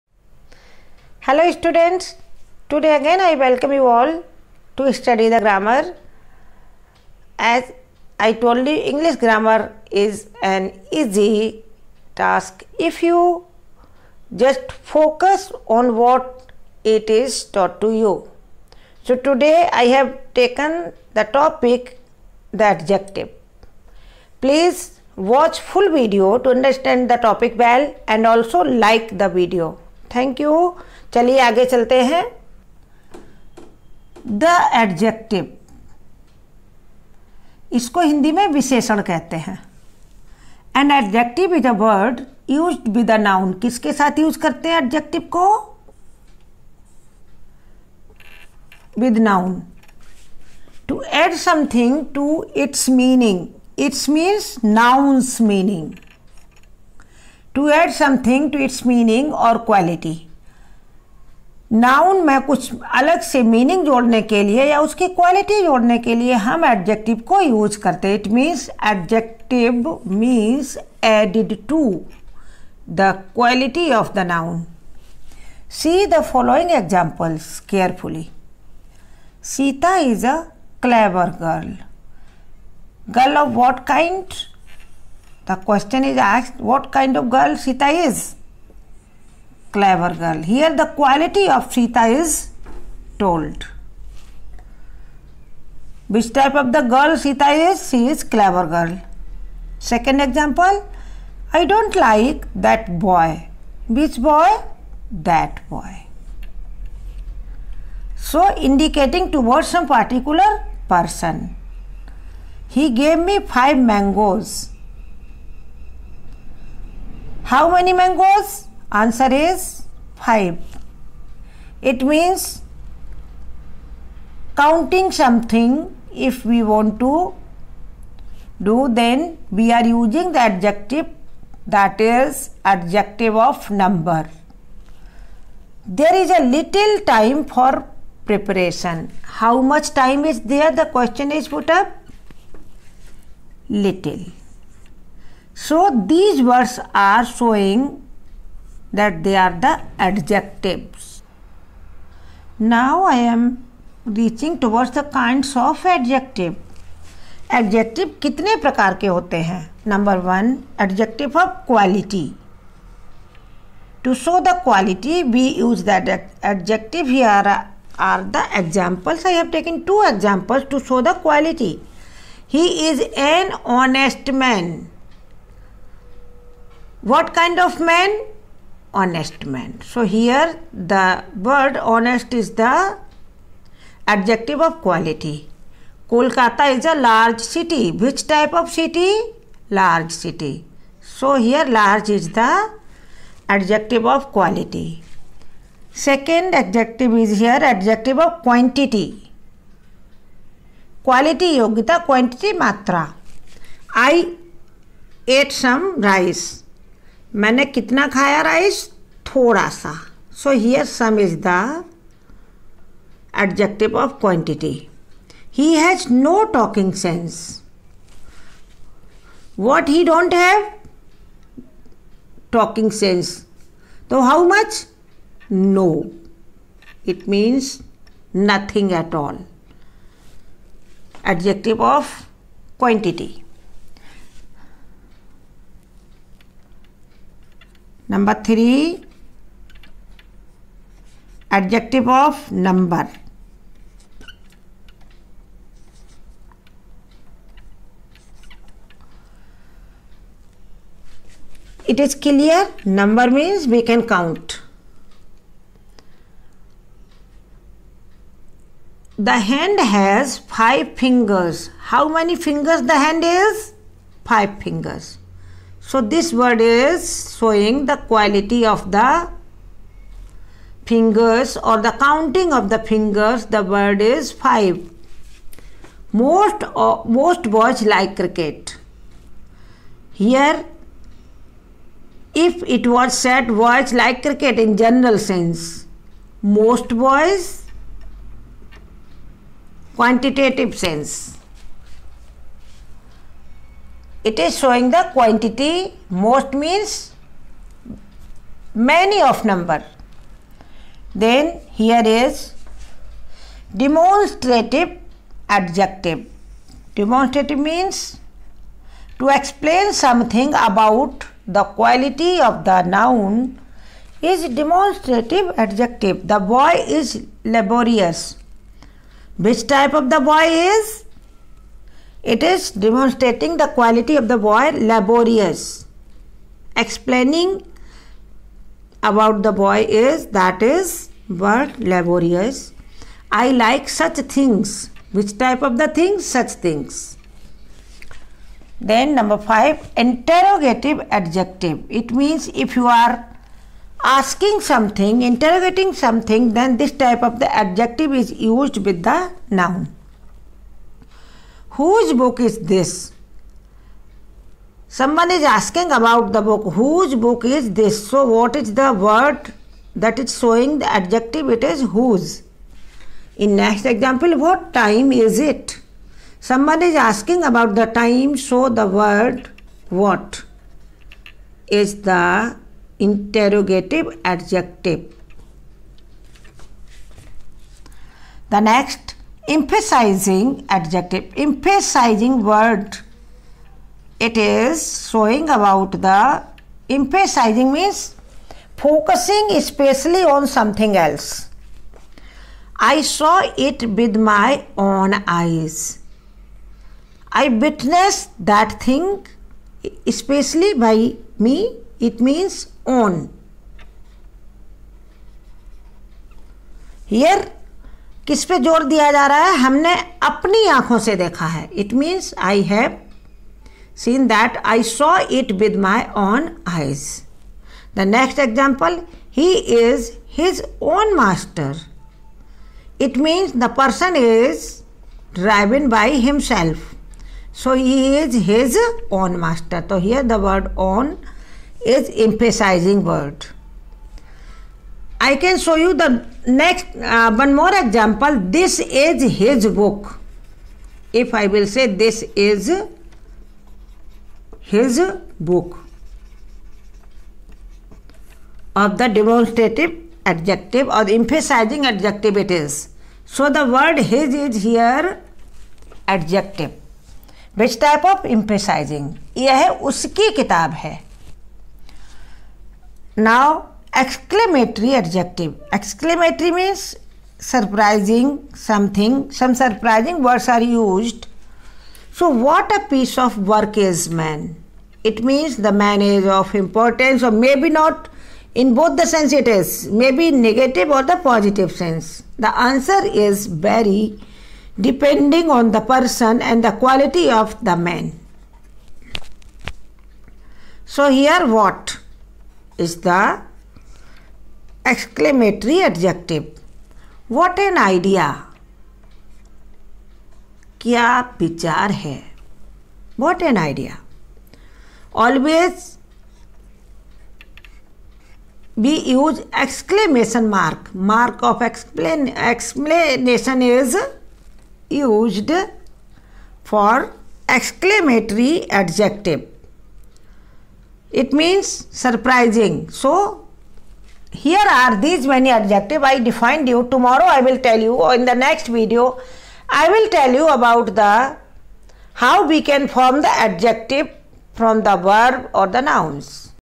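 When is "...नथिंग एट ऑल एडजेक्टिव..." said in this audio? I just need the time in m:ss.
3:48.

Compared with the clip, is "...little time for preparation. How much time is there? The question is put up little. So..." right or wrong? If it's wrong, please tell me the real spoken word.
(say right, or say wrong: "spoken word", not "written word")
right.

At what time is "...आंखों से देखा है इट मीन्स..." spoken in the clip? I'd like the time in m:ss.
6:50.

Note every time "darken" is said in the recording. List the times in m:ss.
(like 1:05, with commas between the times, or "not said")
not said.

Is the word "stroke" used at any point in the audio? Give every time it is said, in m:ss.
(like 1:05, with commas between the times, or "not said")
not said.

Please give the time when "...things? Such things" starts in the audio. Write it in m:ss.
5:35.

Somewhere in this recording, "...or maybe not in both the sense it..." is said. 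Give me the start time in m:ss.
7:57.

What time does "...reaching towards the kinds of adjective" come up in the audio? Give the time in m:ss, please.
2:34.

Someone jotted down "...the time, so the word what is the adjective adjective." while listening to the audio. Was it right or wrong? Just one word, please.
wrong.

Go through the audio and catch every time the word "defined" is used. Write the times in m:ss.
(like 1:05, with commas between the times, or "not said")
8:46.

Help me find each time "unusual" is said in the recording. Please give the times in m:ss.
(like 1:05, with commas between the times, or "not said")
not said.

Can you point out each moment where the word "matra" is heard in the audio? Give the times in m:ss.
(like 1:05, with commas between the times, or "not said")
3:22.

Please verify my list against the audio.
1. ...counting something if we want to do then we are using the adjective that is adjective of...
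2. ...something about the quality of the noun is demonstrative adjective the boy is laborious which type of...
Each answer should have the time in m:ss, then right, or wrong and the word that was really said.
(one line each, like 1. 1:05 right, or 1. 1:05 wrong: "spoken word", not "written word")
1. 2:04 right
2. 5:09 right.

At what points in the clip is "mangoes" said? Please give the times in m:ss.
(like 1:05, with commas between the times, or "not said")
1:53, 1:57.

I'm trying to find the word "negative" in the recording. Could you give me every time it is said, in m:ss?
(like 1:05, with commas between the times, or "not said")
8:00.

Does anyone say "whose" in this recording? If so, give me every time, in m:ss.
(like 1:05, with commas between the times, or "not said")
5:51, 5:56, 6:01.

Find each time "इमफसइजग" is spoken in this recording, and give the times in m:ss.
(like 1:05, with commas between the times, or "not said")
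7:12, 7:31, 7:38.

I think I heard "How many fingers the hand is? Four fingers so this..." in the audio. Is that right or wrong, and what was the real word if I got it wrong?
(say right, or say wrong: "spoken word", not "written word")
wrong: "Five", not "Four".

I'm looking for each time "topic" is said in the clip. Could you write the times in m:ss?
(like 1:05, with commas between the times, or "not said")
0:21, 0:27.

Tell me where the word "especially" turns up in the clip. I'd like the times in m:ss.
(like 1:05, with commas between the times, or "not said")
6:29, 6:40.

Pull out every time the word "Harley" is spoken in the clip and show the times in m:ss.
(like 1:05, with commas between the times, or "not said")
not said.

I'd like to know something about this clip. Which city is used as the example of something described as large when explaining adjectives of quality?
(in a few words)
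Kolkata.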